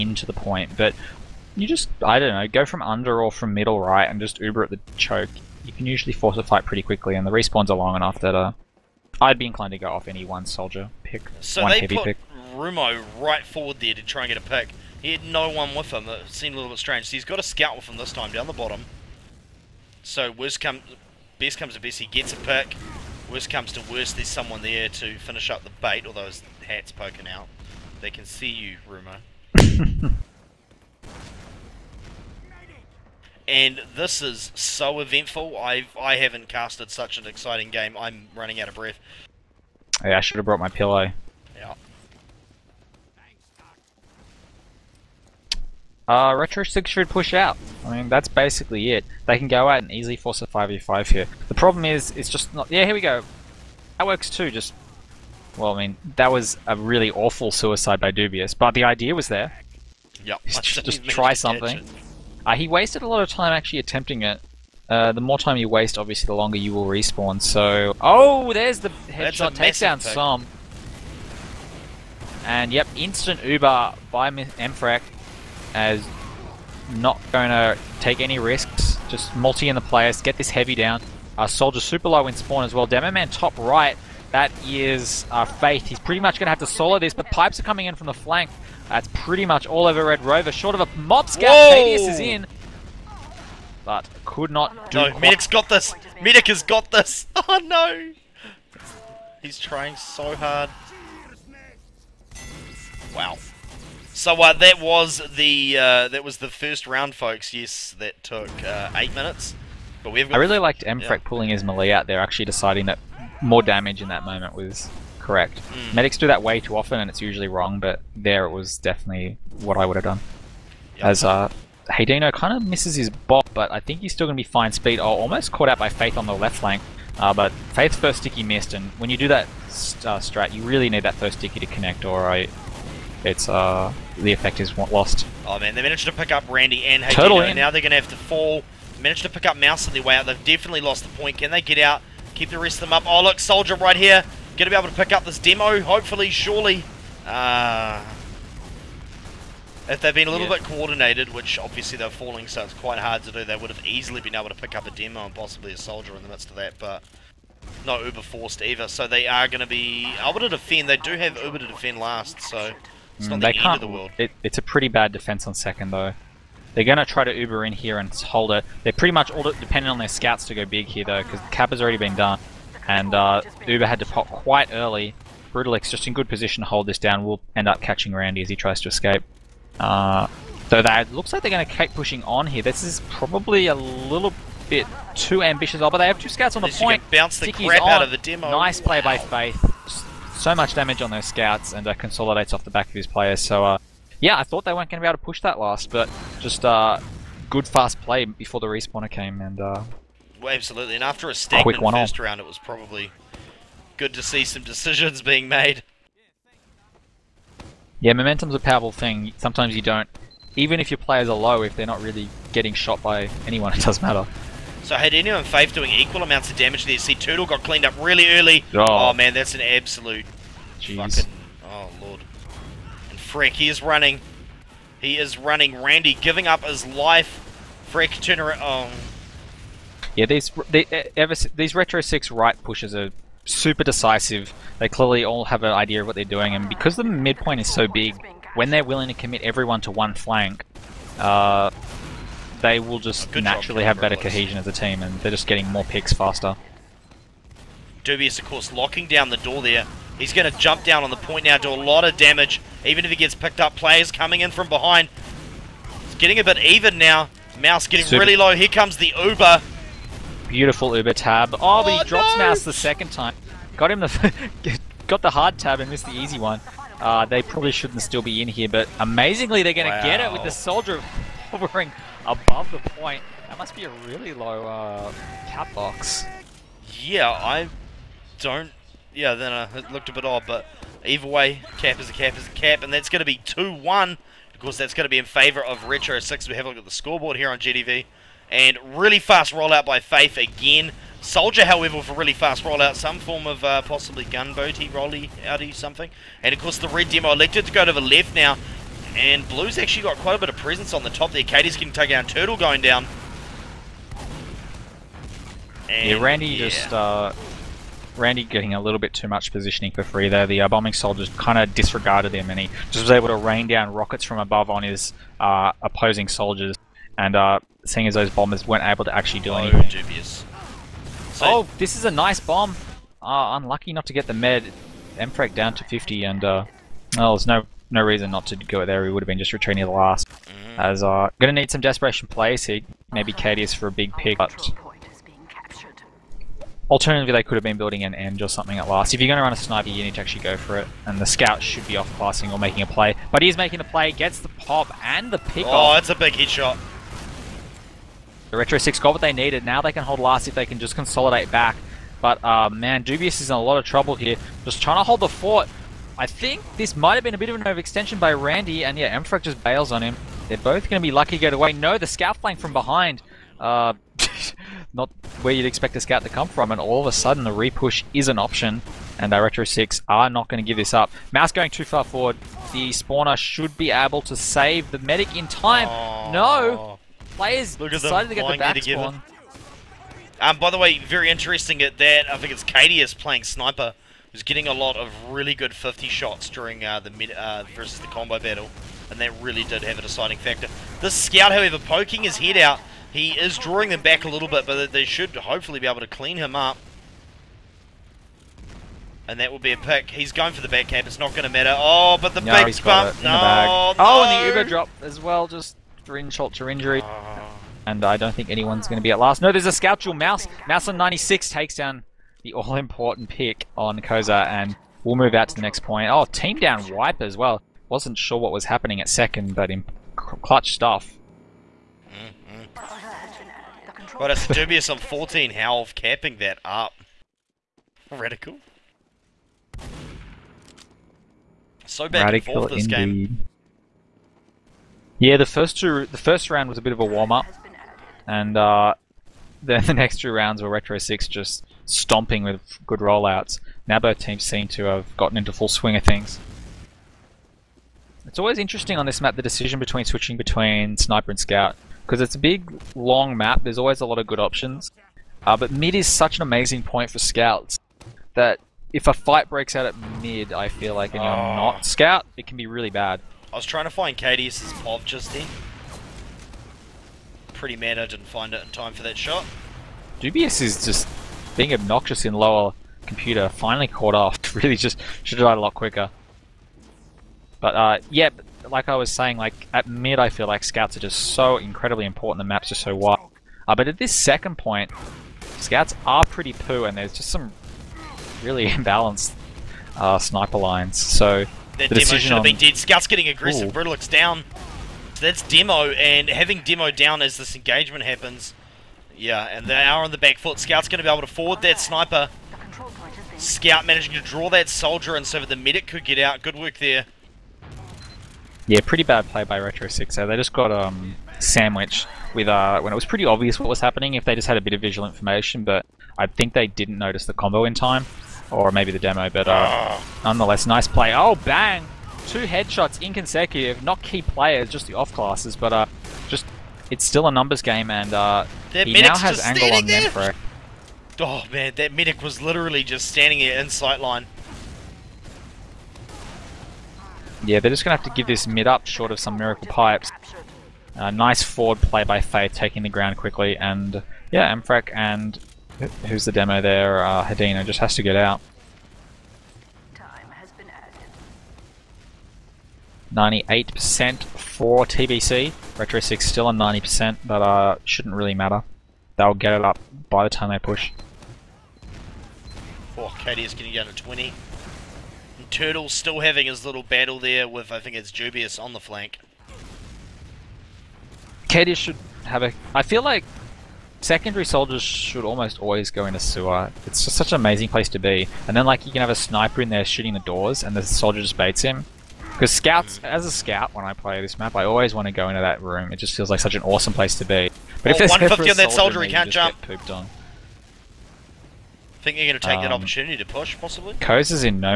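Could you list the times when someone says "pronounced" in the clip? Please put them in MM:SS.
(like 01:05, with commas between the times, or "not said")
not said.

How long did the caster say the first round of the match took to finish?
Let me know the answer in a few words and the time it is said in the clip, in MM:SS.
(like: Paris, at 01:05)
8 minutes, at 01:48.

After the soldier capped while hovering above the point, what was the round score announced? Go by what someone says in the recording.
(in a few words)
2-1.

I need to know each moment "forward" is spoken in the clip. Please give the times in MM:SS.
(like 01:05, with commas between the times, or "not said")
00:13, 06:12, 08:21, 09:01.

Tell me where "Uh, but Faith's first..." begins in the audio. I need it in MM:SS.
02:07.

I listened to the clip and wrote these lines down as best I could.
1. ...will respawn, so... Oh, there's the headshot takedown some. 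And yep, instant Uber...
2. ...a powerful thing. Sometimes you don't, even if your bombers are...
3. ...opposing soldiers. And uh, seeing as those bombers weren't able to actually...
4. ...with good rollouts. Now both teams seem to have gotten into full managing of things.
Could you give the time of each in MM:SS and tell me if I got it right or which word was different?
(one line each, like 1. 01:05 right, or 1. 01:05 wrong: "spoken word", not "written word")
1. 01:06 right
2. 03:28 wrong: "players", not "bombers"
3. 05:15 right
4. 07:22 wrong: "swing", not "managing".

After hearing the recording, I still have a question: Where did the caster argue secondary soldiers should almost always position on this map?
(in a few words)
In a sewer.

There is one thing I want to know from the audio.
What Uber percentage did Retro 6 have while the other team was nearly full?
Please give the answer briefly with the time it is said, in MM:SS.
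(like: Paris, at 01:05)
90%, at 09:16.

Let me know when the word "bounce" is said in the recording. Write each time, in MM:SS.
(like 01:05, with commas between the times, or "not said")
03:07.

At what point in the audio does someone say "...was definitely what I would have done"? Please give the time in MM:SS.
01:58.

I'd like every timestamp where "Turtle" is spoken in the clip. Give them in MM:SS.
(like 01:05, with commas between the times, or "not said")
03:37, 05:02, 09:25.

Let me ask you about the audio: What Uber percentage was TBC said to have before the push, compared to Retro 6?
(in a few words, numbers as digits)
98%.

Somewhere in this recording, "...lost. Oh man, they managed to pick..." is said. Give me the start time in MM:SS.
02:14.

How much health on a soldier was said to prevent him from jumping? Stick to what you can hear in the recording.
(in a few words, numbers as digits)
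150.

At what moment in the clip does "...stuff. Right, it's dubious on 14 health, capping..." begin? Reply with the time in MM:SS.
07:00.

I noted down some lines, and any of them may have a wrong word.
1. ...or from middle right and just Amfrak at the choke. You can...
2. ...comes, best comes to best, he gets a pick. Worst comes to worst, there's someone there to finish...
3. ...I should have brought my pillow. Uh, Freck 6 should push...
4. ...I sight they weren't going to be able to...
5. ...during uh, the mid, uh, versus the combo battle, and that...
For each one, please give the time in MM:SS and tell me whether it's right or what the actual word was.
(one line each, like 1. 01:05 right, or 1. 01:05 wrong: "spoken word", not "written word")
1. 00:03 wrong: "Uber", not "Amfrak"
2. 00:20 right
3. 00:40 wrong: "Retro", not "Freck"
4. 03:14 wrong: "thought", not "sight"
5. 06:26 right.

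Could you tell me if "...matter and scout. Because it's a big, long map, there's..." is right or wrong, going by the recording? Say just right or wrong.
wrong.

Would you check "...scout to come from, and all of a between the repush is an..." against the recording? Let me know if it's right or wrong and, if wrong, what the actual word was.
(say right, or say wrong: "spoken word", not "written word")
wrong: "sudden", not "between".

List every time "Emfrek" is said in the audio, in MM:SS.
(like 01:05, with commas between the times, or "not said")
01:50, 05:59.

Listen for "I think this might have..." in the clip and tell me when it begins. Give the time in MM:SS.
05:56.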